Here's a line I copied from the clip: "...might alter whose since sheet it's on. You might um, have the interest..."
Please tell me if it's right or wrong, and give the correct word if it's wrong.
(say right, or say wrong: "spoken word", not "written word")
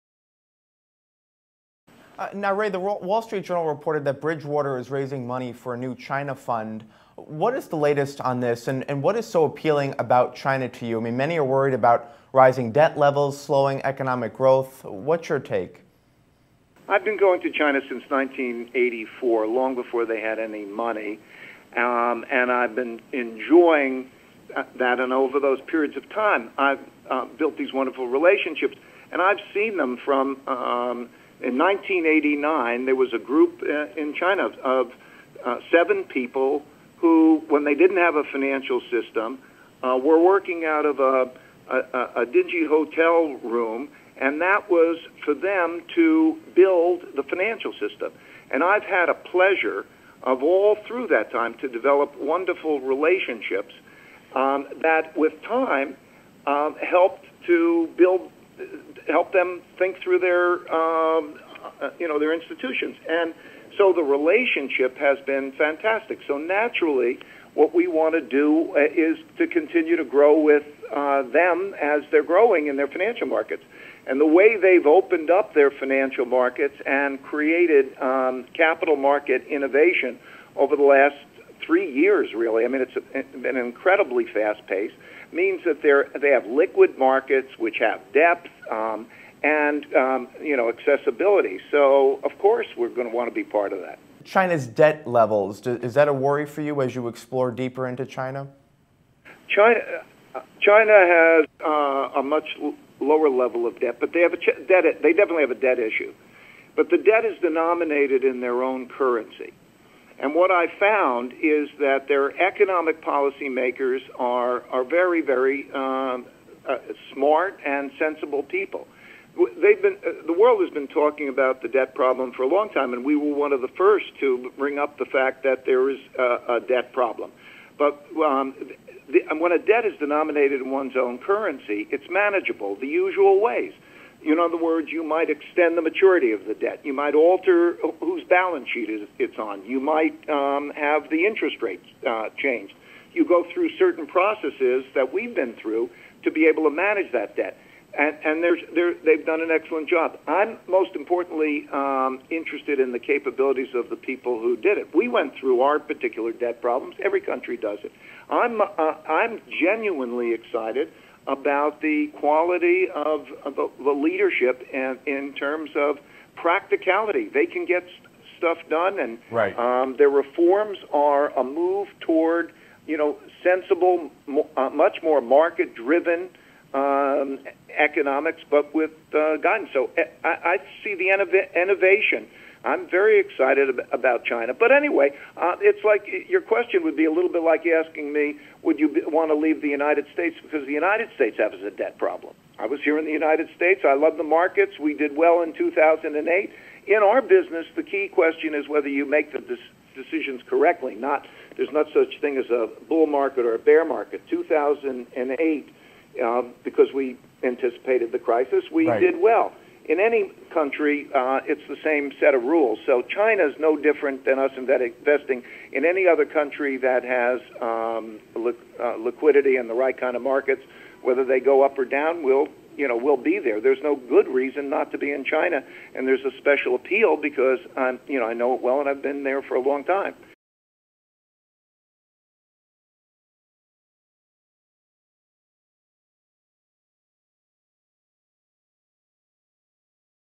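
wrong: "balance", not "since".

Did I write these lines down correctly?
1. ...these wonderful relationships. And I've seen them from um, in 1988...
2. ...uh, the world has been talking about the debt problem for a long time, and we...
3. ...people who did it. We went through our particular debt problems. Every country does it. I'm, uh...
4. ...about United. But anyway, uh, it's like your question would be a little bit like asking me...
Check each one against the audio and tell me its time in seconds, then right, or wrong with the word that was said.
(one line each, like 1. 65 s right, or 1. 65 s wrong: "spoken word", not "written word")
1. 27 s wrong: "1989", not "1988"
2. 120 s right
3. 153 s right
4. 183 s wrong: "China", not "United".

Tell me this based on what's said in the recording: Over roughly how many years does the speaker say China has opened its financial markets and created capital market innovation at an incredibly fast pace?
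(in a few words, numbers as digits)
3 years.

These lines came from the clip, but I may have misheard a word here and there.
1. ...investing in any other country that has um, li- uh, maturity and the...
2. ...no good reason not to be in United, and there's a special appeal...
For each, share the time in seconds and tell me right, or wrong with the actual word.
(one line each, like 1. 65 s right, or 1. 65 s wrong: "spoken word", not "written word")
1. 214 s wrong: "liquidity", not "maturity"
2. 223 s wrong: "China", not "United".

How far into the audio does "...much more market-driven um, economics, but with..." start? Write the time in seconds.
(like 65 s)
174 s.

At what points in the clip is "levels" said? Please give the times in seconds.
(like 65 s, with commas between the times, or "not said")
12 s, 95 s, 103 s.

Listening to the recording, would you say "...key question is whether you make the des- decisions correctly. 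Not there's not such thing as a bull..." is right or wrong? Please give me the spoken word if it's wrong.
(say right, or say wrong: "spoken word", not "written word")
right.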